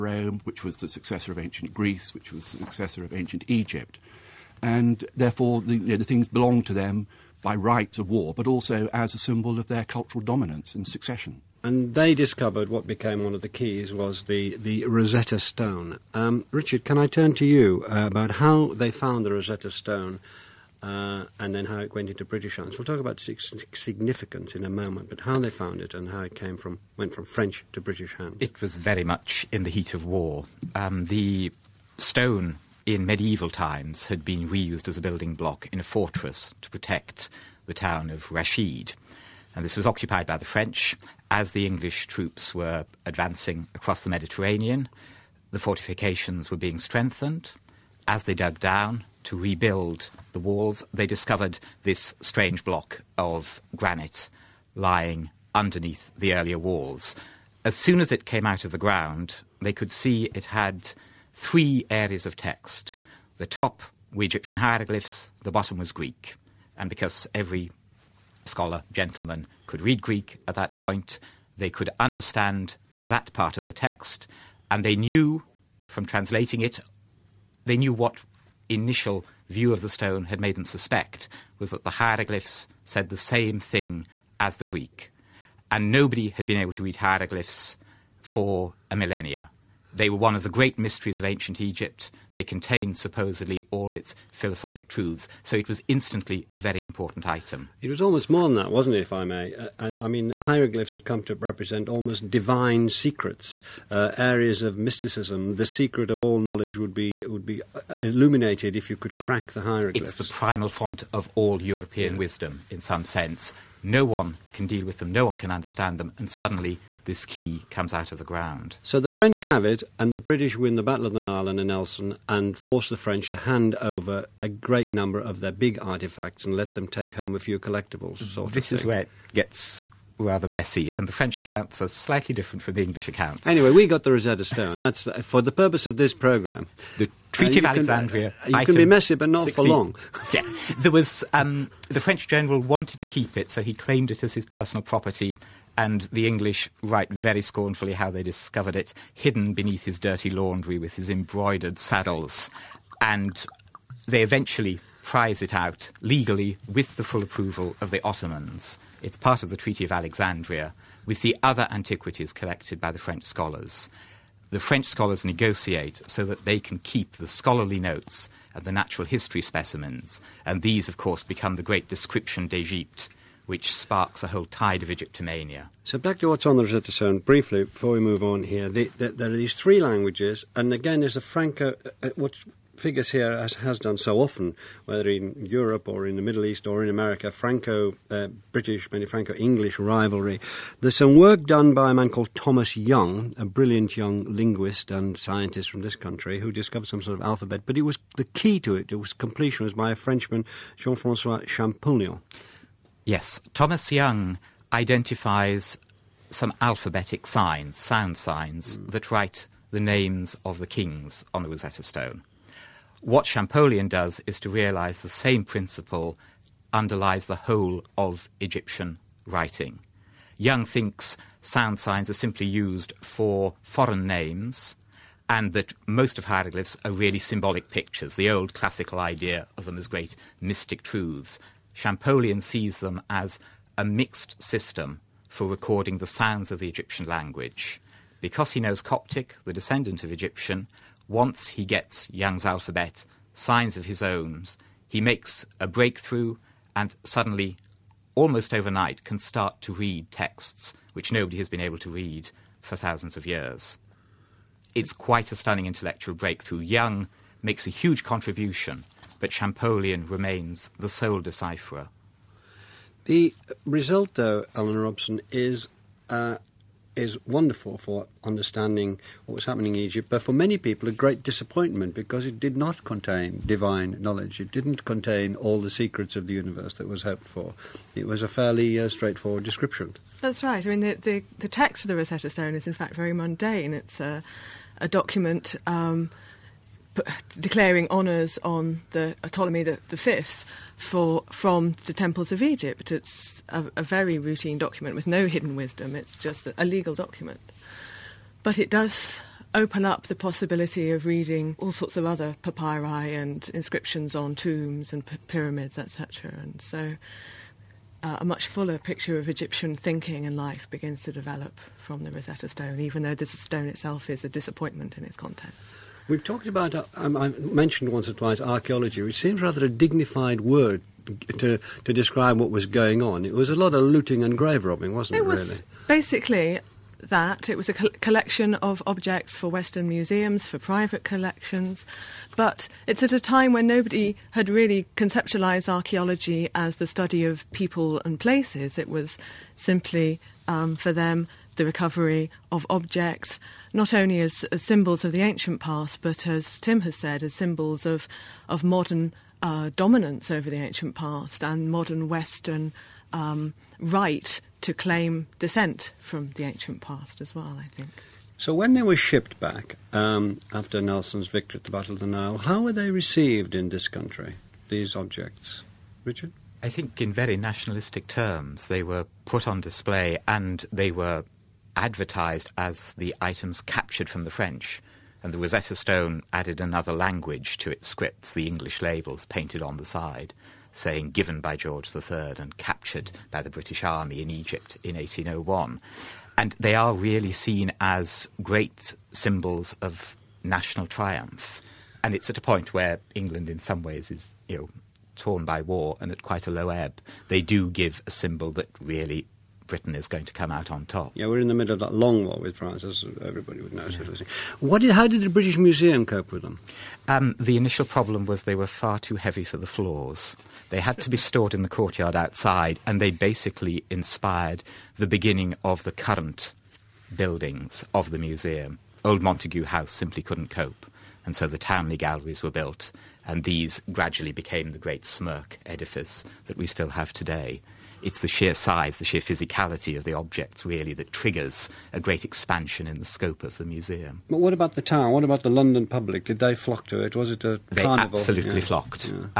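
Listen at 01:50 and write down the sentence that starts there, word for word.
It's the primal font of all European yeah.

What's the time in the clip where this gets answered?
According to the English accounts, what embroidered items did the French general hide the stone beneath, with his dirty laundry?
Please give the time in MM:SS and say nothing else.
02:31.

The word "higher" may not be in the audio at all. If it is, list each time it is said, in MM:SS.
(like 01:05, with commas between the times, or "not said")
not said.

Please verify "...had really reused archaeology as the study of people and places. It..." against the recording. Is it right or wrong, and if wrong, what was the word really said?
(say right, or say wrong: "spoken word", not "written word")
wrong: "conceptualized", not "reused".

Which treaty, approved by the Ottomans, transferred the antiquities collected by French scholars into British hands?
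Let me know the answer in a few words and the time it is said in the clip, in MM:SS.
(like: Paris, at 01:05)
Treaty of Alexandria, at 02:39.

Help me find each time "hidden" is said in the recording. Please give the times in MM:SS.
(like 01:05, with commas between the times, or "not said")
02:29, 04:55.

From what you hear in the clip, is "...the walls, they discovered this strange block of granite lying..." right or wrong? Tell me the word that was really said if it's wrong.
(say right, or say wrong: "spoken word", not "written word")
right.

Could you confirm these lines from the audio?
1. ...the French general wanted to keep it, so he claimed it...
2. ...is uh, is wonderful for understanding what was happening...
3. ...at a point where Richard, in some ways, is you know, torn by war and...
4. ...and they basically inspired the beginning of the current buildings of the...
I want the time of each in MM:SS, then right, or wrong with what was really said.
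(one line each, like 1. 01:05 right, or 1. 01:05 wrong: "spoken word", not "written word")
1. 02:21 right
2. 04:25 right
3. 06:32 wrong: "England", not "Richard"
4. 06:52 right.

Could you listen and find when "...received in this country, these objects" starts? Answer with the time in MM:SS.
06:02.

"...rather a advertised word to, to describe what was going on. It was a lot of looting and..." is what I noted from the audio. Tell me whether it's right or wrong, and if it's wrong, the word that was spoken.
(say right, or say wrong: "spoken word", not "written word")
wrong: "dignified", not "advertised".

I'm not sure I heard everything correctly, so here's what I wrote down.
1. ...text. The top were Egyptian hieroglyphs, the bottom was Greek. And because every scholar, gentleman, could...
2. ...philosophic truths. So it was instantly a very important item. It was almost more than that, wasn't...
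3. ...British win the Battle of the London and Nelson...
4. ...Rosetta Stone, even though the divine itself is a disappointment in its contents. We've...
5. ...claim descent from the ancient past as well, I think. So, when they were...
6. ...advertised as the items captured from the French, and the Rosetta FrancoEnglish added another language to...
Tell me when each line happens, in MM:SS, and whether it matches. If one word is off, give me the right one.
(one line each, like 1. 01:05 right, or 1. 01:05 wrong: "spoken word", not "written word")
1. 01:02 right
2. 01:34 right
3. 02:00 wrong: "Nile", not "London"
4. 05:12 wrong: "stone", not "divine"
5. 05:54 right
6. 06:11 wrong: "Stone", not "FrancoEnglish".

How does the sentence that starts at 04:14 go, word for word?
It's quite a stunning intellectual breakthrough.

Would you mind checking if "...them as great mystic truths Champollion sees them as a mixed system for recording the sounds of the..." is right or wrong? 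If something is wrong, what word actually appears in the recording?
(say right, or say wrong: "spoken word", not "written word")
right.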